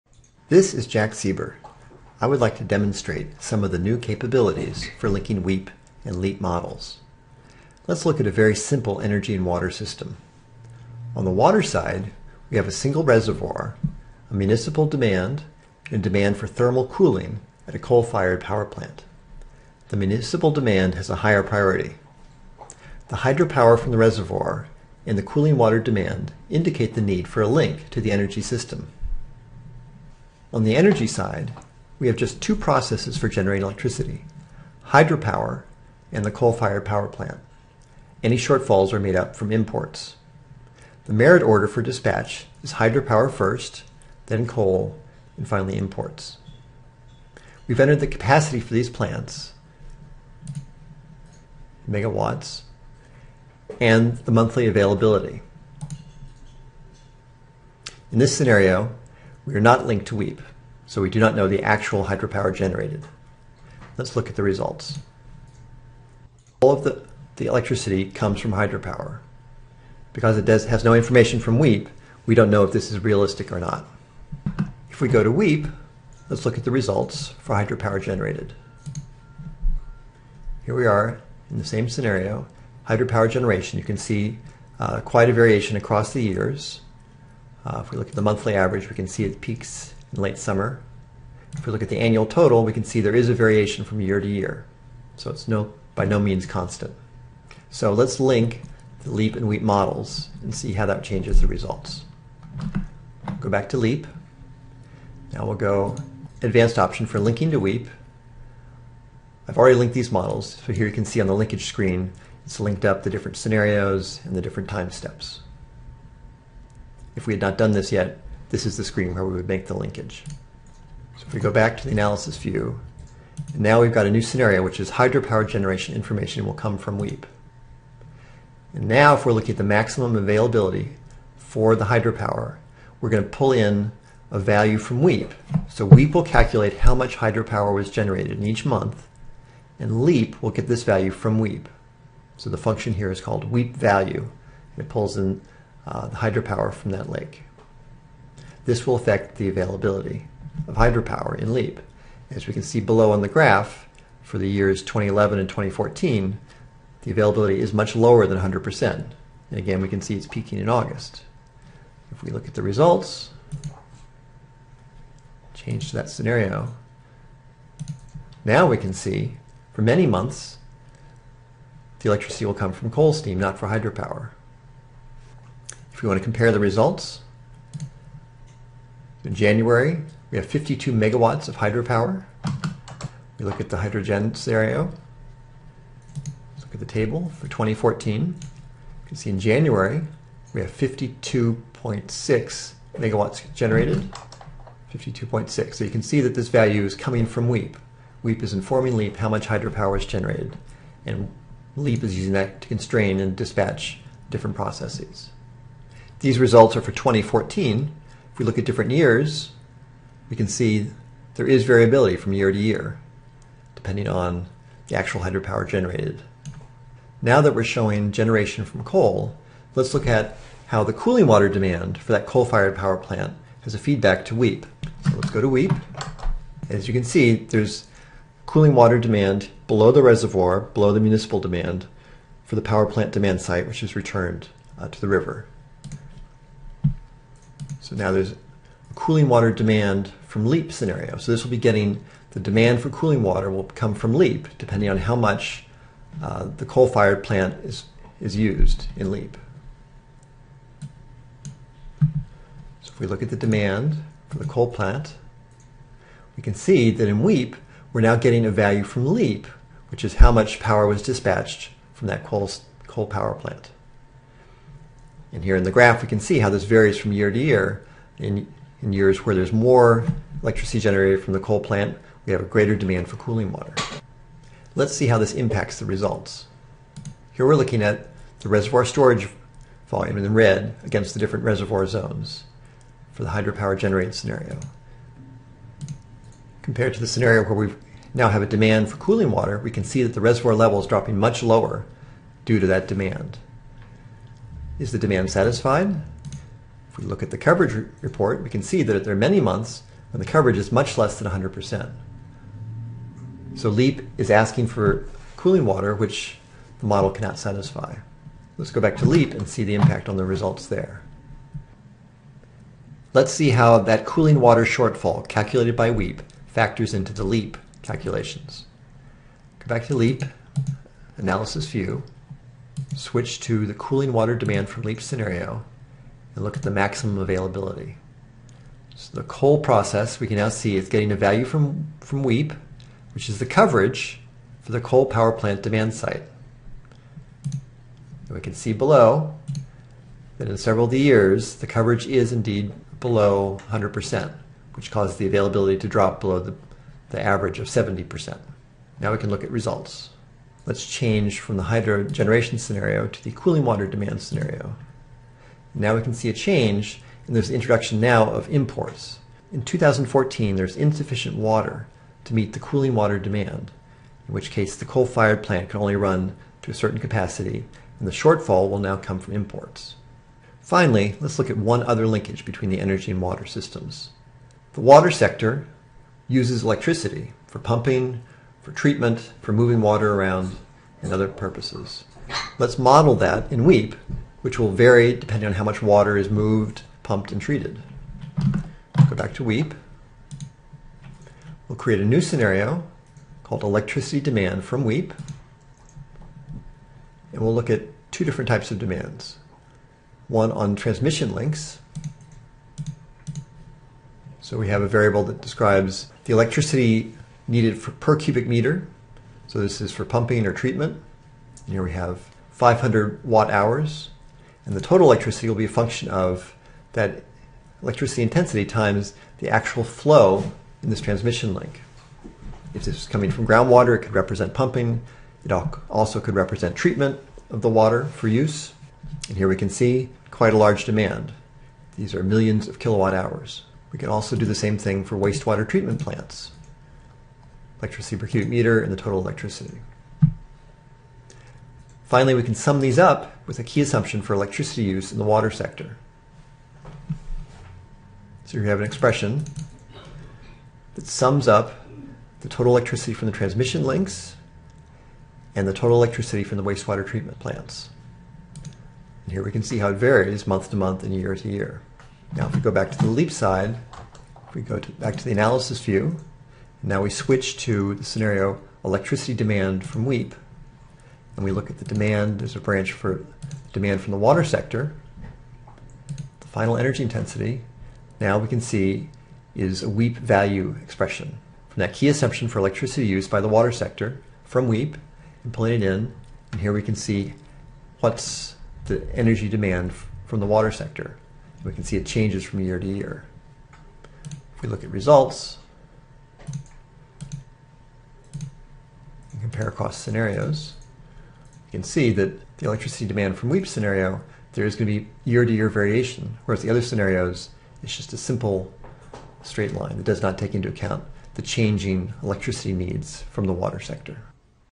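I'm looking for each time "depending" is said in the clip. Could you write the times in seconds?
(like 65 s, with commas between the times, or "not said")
213 s, 244 s, 385 s.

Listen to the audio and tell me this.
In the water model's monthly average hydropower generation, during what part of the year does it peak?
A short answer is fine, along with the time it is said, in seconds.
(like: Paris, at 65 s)
late summer, at 90 s.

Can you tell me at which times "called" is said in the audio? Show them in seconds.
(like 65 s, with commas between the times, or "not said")
143 s, 393 s.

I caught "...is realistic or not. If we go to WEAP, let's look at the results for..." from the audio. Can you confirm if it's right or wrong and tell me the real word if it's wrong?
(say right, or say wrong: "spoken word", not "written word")
right.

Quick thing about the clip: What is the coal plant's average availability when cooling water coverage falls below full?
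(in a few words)
70%.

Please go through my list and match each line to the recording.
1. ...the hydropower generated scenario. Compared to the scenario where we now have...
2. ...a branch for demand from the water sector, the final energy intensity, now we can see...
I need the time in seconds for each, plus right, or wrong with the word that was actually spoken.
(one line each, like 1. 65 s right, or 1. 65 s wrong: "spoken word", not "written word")
1. 283 s right
2. 472 s right.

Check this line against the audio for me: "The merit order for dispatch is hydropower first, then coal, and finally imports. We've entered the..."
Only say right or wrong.
right.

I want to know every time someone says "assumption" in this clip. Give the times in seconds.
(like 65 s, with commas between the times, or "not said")
443 s, 482 s.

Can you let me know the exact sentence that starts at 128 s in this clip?
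And now if we're looking at the maximum availability for the hydropower, we're going to pull in a value from WEAP.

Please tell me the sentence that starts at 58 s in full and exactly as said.
In this scenario, we are not linked to WEAP, so we do not know the actual hydropower generated.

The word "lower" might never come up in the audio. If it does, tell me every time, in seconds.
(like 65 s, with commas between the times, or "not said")
157 s, 291 s.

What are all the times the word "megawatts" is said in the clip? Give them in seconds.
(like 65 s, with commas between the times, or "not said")
51 s, 180 s, 192 s.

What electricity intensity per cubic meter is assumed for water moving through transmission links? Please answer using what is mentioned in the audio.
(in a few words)
500 watt hours.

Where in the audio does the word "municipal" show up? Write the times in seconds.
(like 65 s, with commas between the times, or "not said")
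14 s, 19 s, 230 s.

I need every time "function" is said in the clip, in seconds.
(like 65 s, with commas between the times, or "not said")
142 s, 415 s.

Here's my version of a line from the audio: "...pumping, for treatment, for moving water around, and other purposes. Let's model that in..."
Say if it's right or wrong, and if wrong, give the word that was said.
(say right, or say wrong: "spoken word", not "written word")
right.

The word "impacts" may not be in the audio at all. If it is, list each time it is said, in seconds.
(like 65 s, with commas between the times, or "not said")
275 s, 309 s.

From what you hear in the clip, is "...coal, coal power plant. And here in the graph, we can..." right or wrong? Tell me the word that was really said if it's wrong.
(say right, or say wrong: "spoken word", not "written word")
right.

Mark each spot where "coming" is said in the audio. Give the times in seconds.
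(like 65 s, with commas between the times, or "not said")
196 s, 423 s.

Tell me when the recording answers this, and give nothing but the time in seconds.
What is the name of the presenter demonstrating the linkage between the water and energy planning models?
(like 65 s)
0 s.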